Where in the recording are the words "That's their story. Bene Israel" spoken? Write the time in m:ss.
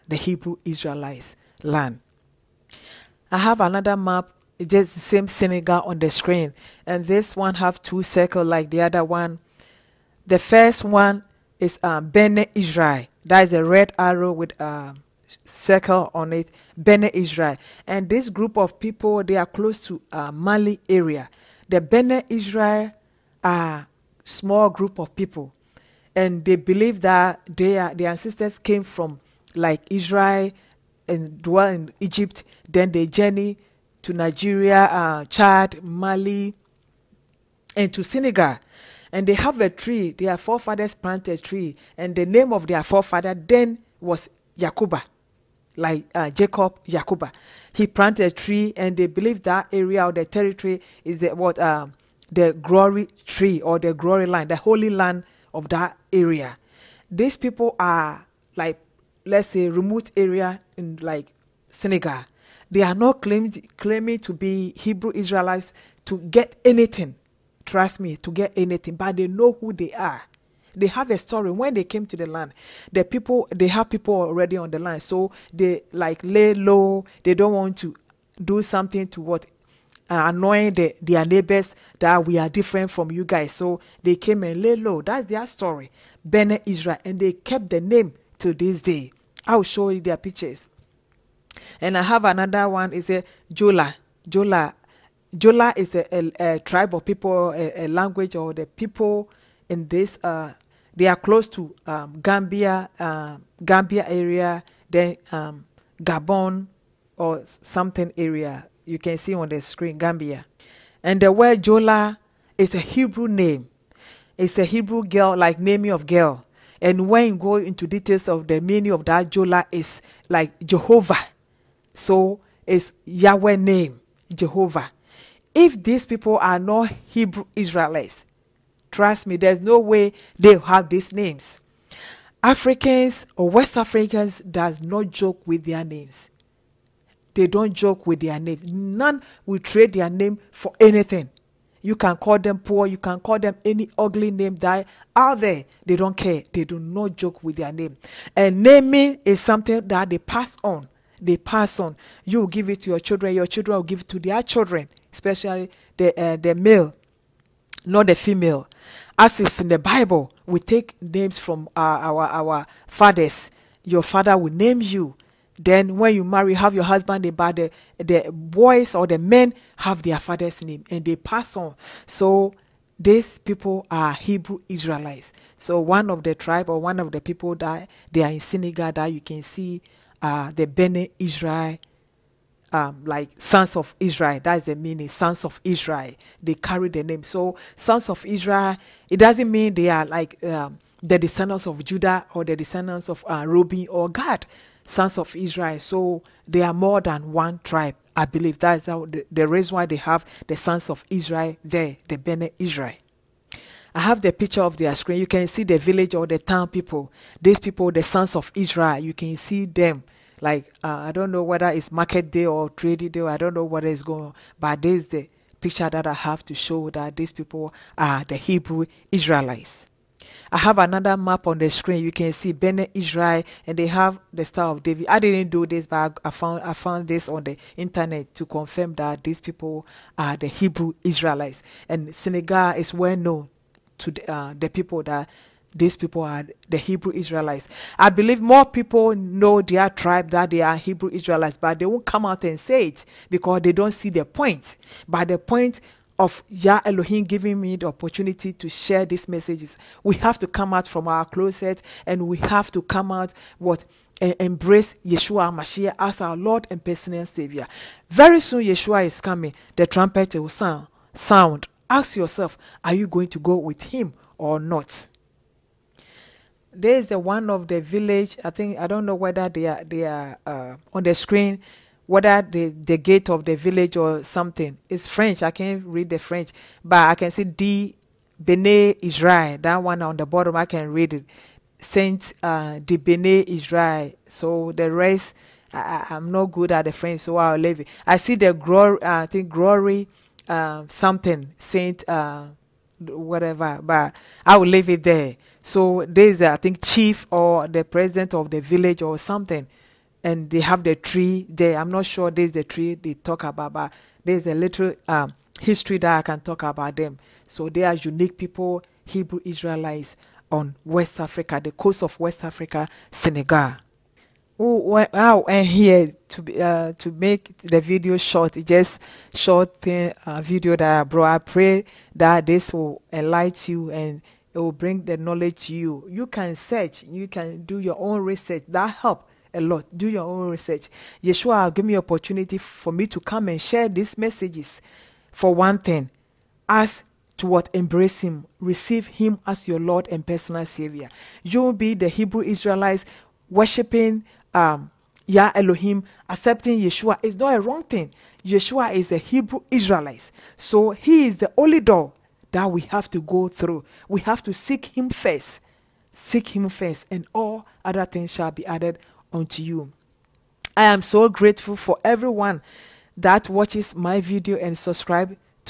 1:25.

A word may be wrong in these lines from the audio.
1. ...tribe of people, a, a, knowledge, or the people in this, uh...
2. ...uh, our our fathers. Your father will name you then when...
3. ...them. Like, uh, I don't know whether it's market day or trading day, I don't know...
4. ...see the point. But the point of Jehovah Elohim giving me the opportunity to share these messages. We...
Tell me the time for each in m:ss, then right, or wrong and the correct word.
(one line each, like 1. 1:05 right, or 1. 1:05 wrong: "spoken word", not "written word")
1. 1:36 wrong: "language", not "knowledge"
2. 2:41 right
3. 3:29 right
4. 4:03 wrong: "Yah", not "Jehovah".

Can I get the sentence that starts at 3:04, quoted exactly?
That's the meaning, sons of Israel.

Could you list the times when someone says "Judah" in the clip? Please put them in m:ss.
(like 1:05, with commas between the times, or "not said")
3:11.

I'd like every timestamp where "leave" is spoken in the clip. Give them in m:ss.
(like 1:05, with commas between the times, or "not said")
4:47, 4:54.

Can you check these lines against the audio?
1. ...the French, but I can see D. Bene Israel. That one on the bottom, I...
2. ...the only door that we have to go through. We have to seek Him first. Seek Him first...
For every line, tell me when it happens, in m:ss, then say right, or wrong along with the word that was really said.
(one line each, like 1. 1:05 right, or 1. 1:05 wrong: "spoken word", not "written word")
1. 4:36 right
2. 5:51 right.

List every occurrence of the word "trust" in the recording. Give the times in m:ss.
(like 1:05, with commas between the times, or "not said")
1:07, 2:08.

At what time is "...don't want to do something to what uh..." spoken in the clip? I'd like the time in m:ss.
1:17.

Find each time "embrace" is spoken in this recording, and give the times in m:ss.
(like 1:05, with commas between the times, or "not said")
4:14, 5:37.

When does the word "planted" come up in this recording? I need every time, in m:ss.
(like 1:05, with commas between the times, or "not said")
0:40, 0:47.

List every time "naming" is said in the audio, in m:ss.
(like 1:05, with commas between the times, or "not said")
1:55, 2:28.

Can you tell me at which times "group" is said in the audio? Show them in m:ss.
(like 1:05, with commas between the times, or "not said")
0:18, 0:24.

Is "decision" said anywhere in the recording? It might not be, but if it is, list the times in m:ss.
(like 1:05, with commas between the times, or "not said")
not said.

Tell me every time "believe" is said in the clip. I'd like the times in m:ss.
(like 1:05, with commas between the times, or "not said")
0:26, 0:49, 3:18, 3:58.